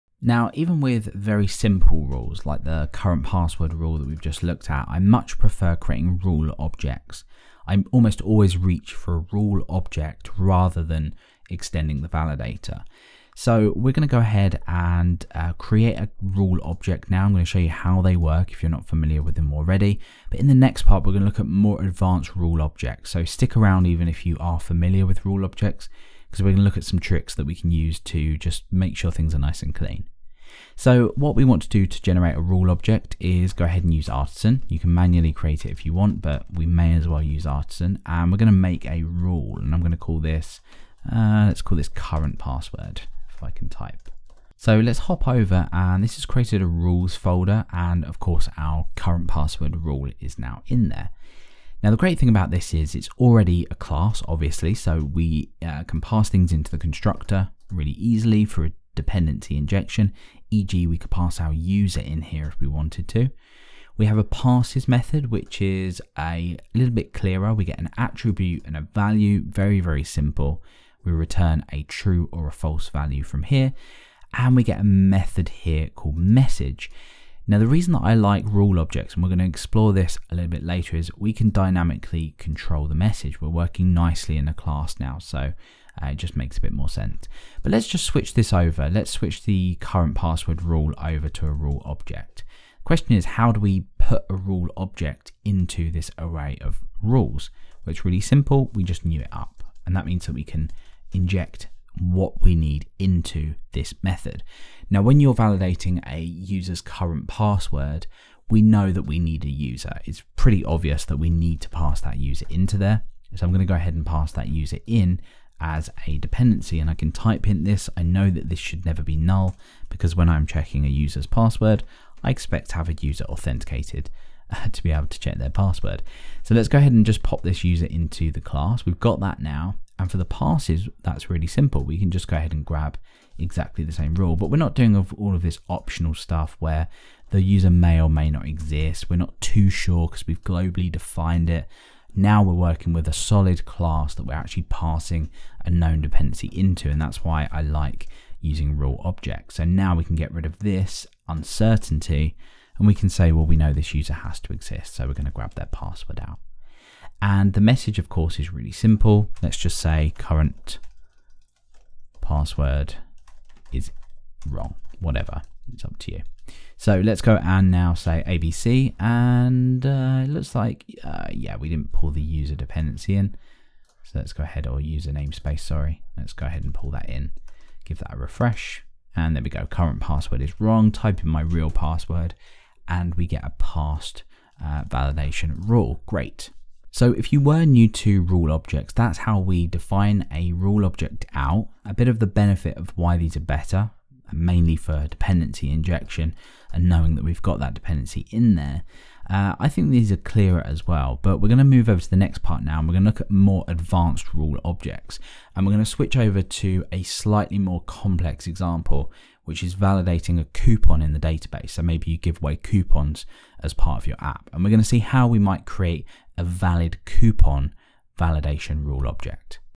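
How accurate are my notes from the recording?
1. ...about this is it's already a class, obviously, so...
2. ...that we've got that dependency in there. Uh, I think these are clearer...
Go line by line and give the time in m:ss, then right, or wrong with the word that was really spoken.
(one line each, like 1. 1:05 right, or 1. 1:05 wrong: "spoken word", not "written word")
1. 0:52 right
2. 3:17 right.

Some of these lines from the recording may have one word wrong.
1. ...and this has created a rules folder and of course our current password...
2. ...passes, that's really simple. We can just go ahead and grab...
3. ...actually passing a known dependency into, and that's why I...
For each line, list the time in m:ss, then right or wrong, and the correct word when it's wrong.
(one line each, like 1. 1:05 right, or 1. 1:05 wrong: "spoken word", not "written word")
1. 0:45 right
2. 2:10 right
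3. 2:24 right.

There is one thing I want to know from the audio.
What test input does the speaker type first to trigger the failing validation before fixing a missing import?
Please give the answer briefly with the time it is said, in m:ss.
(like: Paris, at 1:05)
ABC, at 2:48.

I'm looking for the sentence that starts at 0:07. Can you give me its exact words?
I almost always reach for a rule object rather than extending the validator.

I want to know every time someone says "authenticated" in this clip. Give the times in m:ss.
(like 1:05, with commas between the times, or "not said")
2:03.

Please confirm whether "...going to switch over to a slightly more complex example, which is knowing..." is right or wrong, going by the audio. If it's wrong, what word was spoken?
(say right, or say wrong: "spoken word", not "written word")
wrong: "validating", not "knowing".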